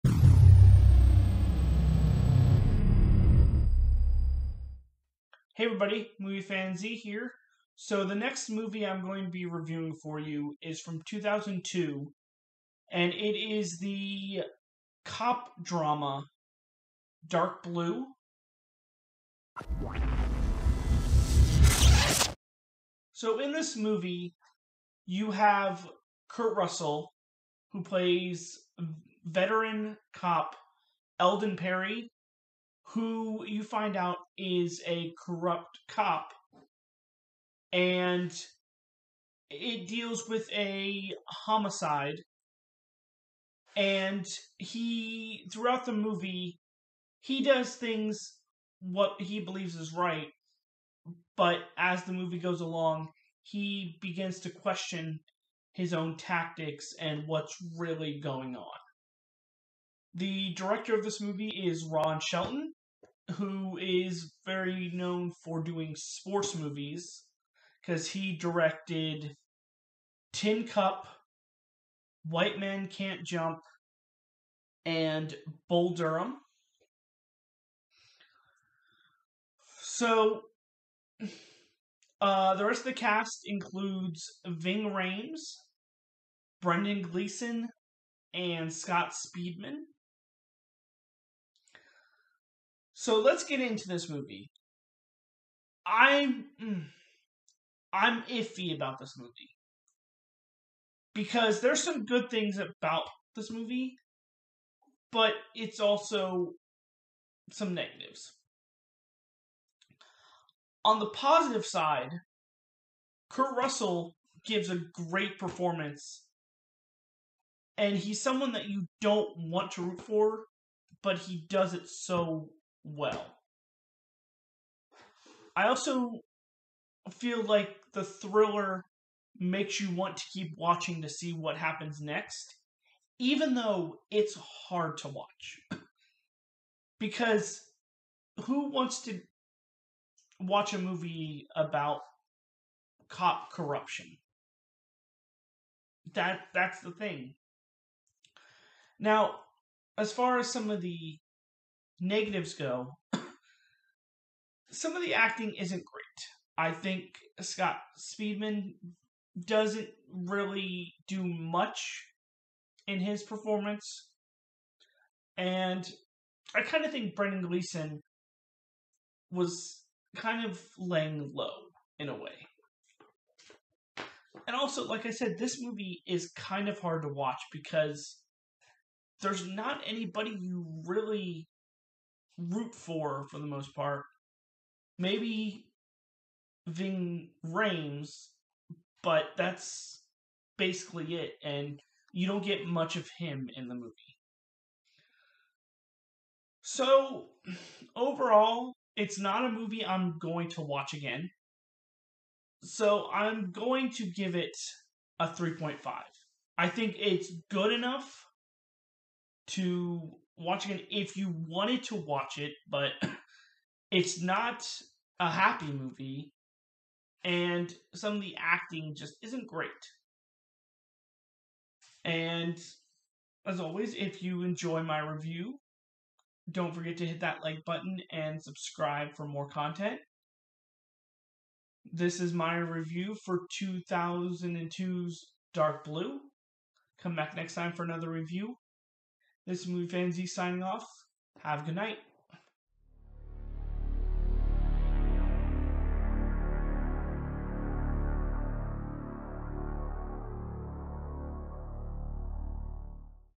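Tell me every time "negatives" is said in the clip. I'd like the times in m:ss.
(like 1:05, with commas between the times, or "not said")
1:47, 2:32.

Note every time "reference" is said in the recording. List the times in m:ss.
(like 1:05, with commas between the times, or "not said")
not said.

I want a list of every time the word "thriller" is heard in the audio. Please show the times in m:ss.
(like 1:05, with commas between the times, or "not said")
2:08.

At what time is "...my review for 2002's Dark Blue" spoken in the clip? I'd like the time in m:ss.
3:52.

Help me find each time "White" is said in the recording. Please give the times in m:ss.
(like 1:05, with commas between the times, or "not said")
1:12.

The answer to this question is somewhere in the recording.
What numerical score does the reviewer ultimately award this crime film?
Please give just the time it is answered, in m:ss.
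3:25.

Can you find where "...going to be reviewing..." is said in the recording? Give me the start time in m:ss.
0:09.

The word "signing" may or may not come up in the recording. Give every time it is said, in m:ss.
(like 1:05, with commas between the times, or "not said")
4:00.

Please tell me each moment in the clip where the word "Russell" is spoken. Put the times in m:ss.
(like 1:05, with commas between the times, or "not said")
0:26, 1:53.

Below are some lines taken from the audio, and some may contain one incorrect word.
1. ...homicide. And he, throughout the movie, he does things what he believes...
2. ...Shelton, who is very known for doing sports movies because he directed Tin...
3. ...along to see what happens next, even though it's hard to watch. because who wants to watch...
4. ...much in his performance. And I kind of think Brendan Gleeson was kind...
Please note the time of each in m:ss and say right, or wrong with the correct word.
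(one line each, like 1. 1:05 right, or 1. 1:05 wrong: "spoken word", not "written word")
1. 0:41 right
2. 1:02 right
3. 2:10 wrong: "watching", not "along"
4. 2:41 right.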